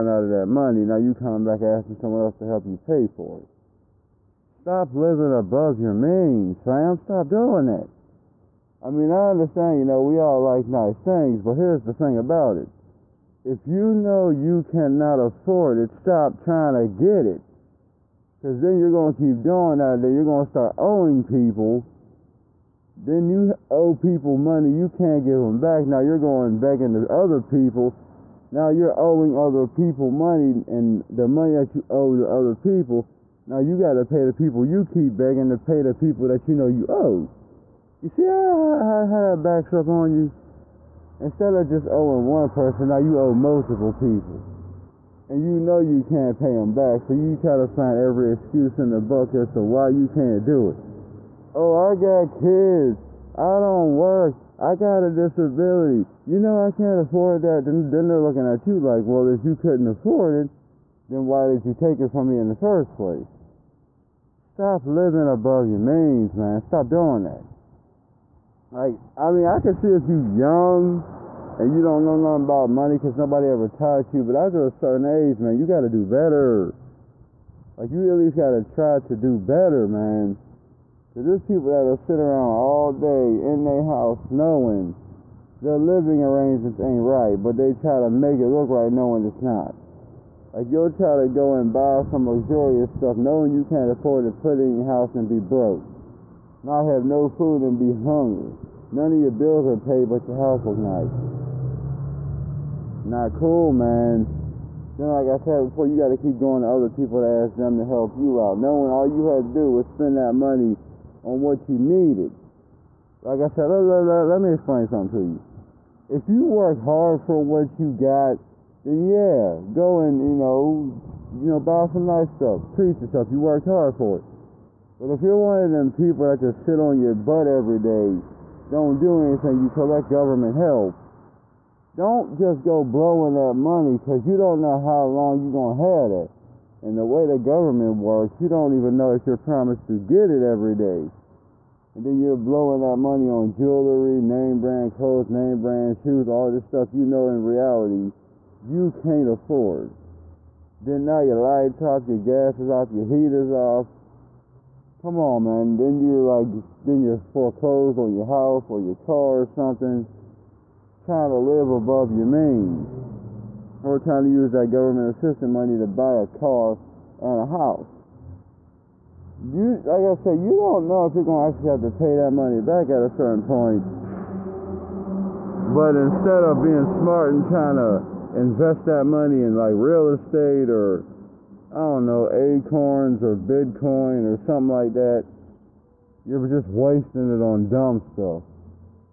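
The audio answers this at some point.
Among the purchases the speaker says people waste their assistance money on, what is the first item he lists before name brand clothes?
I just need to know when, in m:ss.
2:23.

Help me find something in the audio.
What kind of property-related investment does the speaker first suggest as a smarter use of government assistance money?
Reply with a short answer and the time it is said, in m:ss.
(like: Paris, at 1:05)
real estate, at 2:59.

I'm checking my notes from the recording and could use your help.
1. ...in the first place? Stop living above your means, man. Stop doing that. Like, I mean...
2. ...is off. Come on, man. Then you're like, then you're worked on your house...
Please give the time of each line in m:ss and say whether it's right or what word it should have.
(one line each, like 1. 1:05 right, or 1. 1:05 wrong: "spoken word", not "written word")
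1. 1:02 right
2. 2:33 wrong: "foreclosed", not "worked".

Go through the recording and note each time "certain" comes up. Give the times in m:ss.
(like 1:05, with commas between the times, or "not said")
1:14, 2:53.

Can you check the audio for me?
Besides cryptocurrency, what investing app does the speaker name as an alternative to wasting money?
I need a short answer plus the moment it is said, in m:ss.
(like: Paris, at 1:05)
Acorns, at 3:02.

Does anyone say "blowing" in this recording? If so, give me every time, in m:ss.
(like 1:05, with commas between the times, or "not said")
2:12, 2:22.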